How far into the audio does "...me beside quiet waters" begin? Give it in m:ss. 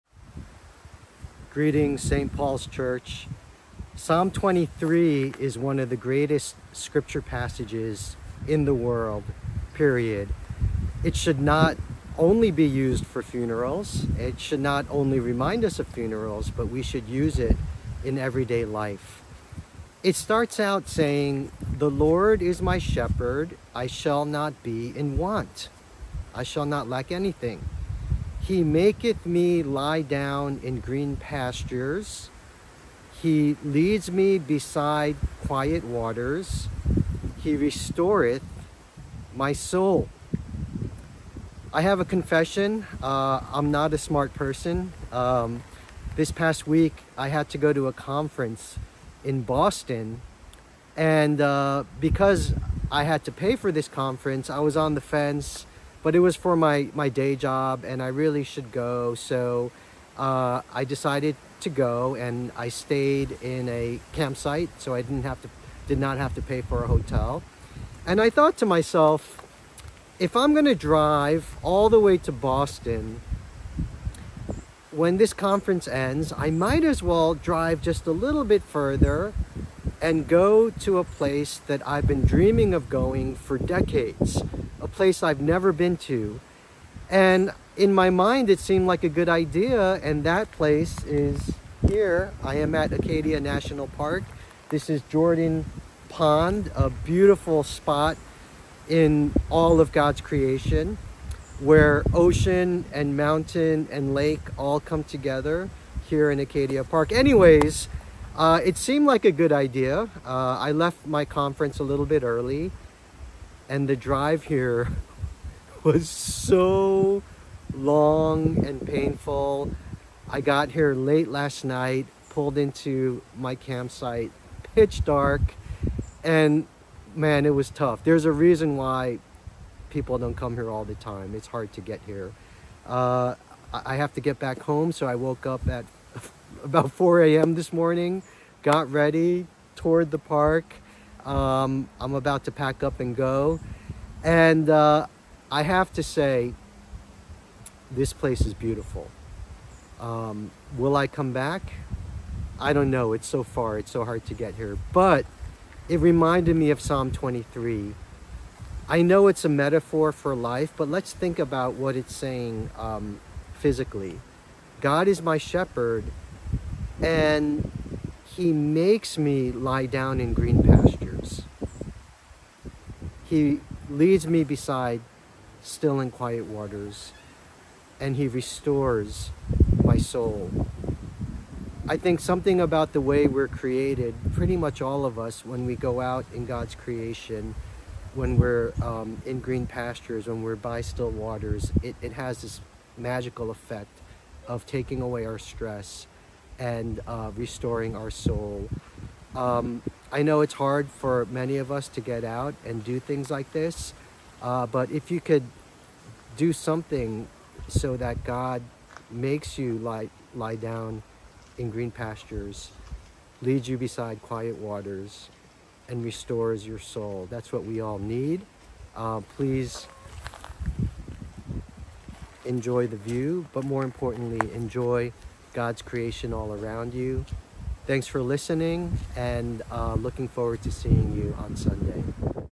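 0:34.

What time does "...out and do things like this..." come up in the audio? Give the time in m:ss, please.
3:22.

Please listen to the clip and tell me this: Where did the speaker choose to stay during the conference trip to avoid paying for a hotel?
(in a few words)
a campsite.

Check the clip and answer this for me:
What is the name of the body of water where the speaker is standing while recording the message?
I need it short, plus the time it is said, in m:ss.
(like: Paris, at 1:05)
Jordan Pond, at 1:35.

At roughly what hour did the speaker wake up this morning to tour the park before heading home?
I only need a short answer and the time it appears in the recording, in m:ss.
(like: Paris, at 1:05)
4 a.m., at 2:16.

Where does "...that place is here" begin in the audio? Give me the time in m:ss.
1:30.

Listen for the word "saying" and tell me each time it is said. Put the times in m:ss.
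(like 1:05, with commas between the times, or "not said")
0:20, 2:42.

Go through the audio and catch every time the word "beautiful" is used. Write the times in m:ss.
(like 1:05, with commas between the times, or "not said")
1:36, 2:28.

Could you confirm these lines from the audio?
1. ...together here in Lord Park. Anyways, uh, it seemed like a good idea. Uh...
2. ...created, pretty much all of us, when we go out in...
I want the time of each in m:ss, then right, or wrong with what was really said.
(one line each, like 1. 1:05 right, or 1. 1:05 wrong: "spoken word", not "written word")
1. 1:45 wrong: "Acadia", not "Lord"
2. 3:03 right.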